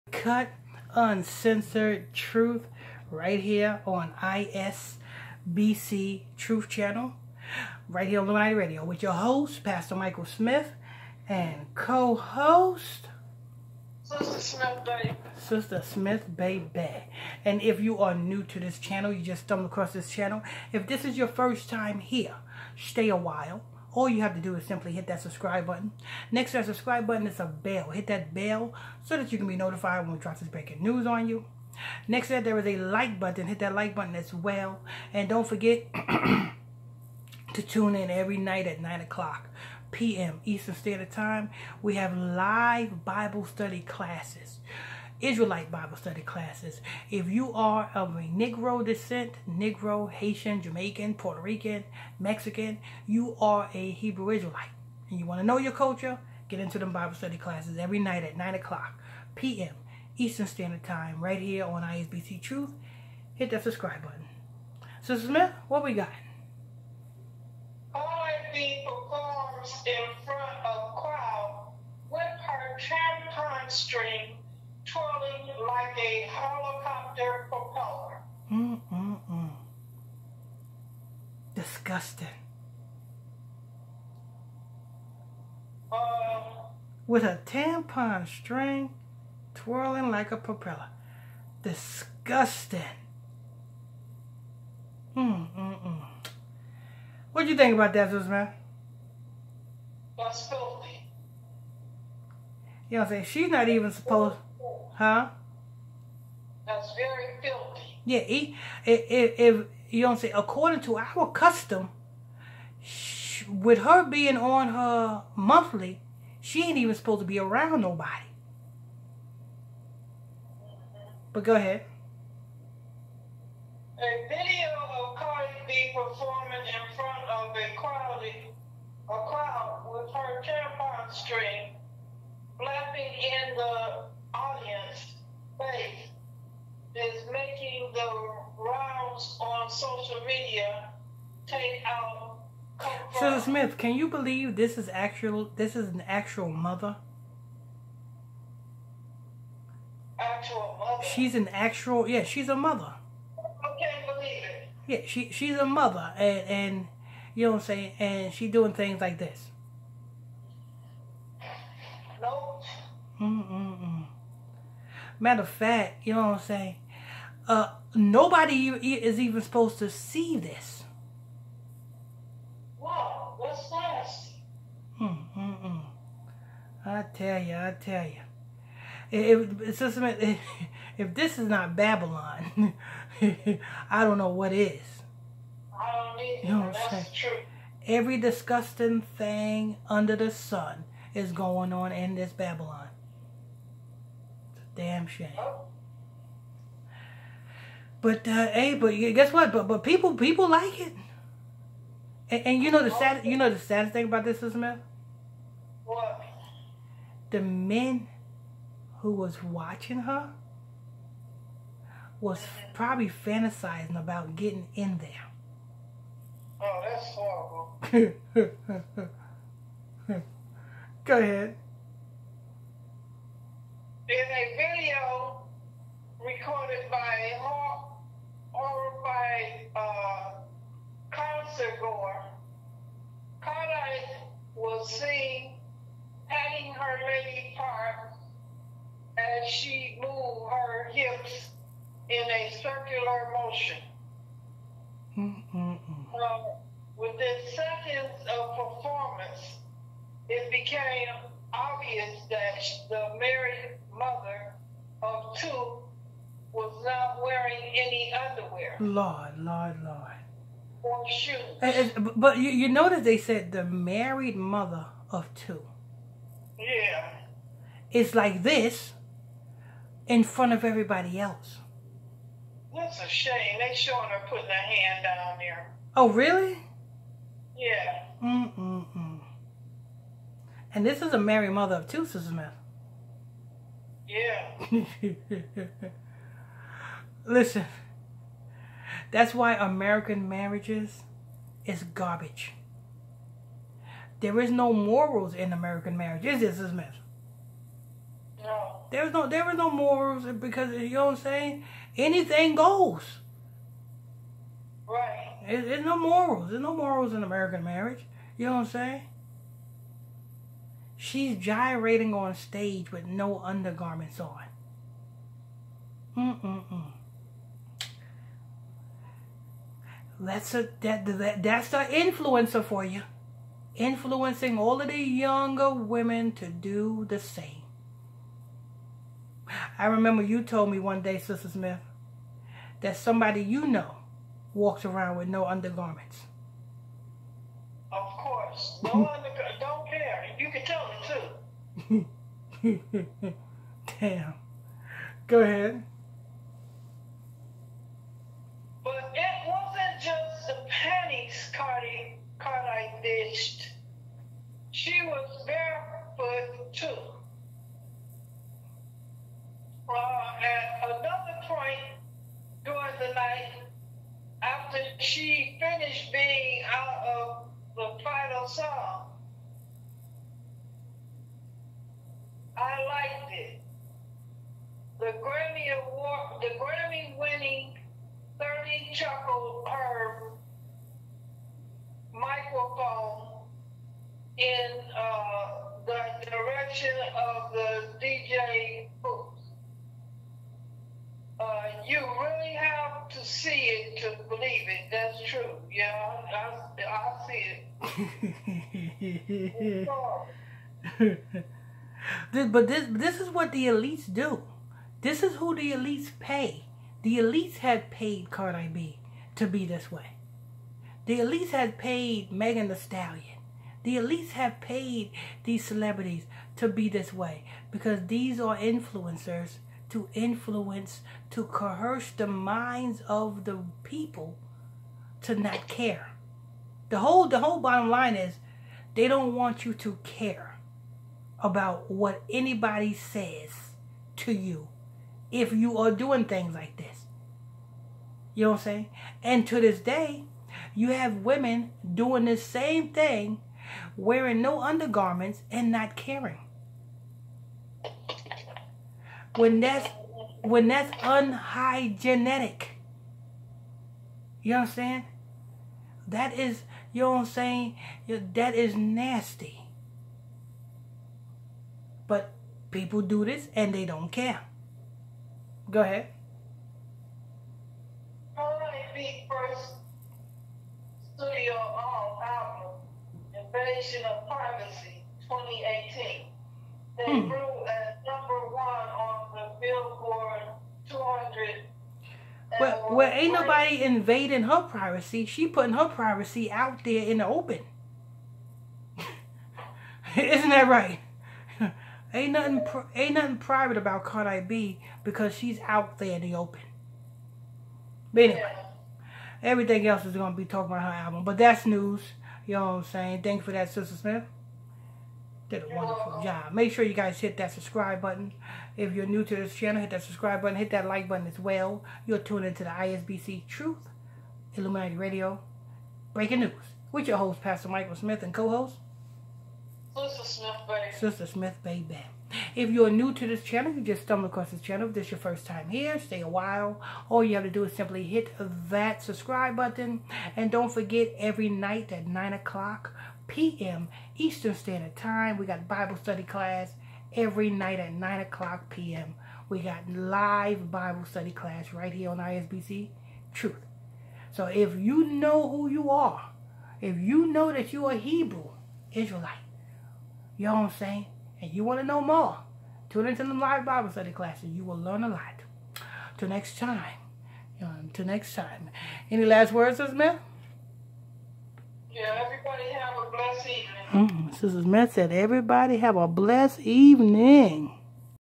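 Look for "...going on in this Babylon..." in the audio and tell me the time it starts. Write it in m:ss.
3:11.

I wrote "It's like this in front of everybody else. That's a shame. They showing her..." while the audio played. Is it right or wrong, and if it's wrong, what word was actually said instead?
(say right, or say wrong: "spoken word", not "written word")
right.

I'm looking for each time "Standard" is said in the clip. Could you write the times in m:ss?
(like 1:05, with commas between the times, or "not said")
0:40, 1:00, 8:54.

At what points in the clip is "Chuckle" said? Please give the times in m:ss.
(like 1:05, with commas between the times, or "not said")
6:18.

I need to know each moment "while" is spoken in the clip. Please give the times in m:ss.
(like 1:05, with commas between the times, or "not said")
0:23, 8:46.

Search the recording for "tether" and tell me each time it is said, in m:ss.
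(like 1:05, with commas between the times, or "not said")
not said.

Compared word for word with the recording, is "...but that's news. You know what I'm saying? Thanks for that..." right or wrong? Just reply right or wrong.
right.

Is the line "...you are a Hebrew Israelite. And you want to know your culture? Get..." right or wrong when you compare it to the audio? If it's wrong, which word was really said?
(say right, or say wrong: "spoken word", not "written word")
right.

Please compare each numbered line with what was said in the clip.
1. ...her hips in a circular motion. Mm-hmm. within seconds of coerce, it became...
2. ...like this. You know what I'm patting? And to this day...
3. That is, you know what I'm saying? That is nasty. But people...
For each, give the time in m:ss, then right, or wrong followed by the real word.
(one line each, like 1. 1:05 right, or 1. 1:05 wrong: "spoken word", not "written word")
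1. 4:00 wrong: "performance", not "coerce"
2. 7:16 wrong: "saying", not "patting"
3. 7:36 right.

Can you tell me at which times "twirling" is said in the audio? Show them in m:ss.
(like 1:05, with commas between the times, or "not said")
1:14, 1:29.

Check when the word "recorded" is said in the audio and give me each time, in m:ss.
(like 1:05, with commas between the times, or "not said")
3:46.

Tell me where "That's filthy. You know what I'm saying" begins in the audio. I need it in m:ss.
1:40.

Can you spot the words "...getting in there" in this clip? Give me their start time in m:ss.
3:34.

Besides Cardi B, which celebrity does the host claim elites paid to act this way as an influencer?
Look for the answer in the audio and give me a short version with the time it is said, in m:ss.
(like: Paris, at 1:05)
Megan Thee Stallion, at 6:52.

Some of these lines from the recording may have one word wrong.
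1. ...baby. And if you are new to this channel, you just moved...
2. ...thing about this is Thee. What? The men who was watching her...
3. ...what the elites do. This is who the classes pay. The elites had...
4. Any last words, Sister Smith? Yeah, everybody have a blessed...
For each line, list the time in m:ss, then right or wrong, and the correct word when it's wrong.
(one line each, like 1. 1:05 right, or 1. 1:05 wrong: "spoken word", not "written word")
1. 0:16 wrong: "stumbled", not "moved"
2. 3:23 wrong: "Smith", not "Thee"
3. 6:43 wrong: "elites", not "classes"
4. 9:19 right.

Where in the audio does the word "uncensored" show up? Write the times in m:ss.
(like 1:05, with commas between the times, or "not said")
0:00.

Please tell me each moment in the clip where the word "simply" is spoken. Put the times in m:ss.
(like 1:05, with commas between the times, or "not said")
0:24, 8:47.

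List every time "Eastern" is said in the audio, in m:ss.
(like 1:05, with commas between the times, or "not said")
0:40, 1:00, 8:54.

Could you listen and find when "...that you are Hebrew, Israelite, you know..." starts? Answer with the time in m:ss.
9:07.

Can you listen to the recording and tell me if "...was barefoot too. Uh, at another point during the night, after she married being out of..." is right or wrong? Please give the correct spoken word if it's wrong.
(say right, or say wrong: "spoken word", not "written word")
wrong: "finished", not "married".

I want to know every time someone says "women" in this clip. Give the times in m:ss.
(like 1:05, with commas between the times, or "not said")
5:25, 7:21.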